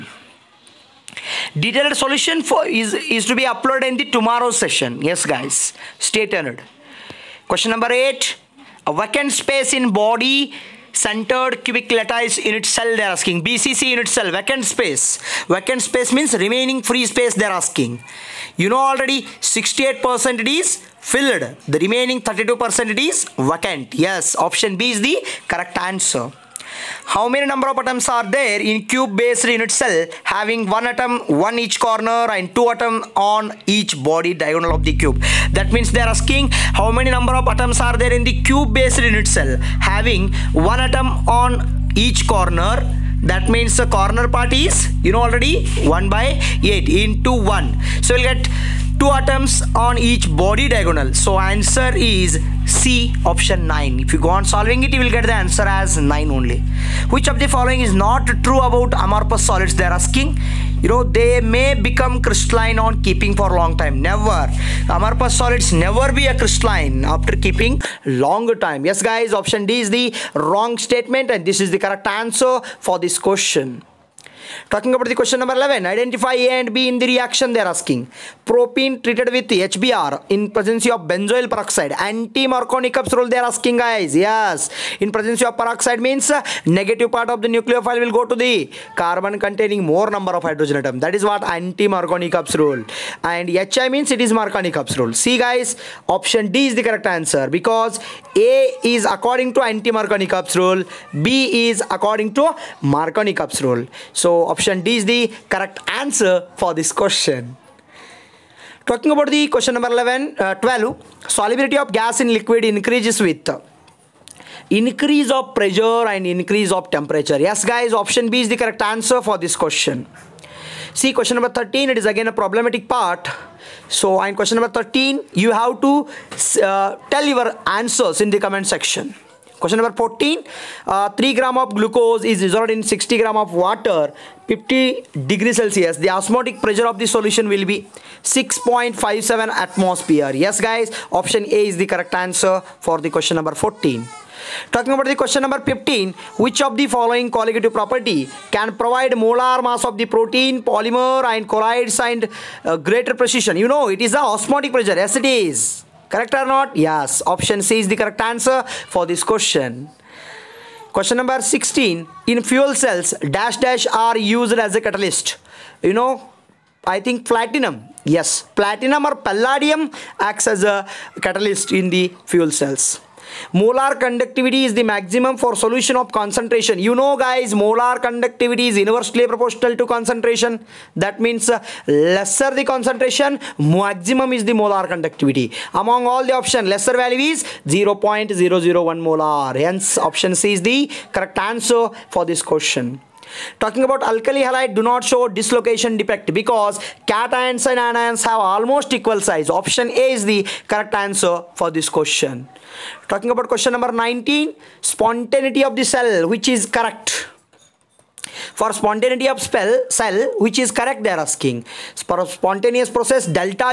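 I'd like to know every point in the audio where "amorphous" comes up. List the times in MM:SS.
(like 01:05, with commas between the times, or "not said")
00:59, 01:04.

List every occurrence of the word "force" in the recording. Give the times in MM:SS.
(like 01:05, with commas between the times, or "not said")
not said.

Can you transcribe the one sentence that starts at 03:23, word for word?
Talking about question number 19, spontaneity of the cell which is correct.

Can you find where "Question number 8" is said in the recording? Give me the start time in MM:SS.
00:07.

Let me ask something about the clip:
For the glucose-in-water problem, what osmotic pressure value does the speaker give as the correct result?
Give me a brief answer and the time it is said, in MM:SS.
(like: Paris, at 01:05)
6.57 atmosphere, at 02:18.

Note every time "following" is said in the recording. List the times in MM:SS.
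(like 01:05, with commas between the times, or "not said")
00:57, 02:26.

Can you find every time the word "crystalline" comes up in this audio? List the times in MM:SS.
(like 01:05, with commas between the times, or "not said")
01:02, 01:06.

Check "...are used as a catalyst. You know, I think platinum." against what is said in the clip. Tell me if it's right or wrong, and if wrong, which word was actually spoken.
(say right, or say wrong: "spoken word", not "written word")
right.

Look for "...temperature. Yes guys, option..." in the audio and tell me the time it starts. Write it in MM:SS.
01:56.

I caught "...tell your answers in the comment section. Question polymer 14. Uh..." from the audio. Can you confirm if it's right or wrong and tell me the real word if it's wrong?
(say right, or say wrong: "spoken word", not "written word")
wrong: "number", not "polymer".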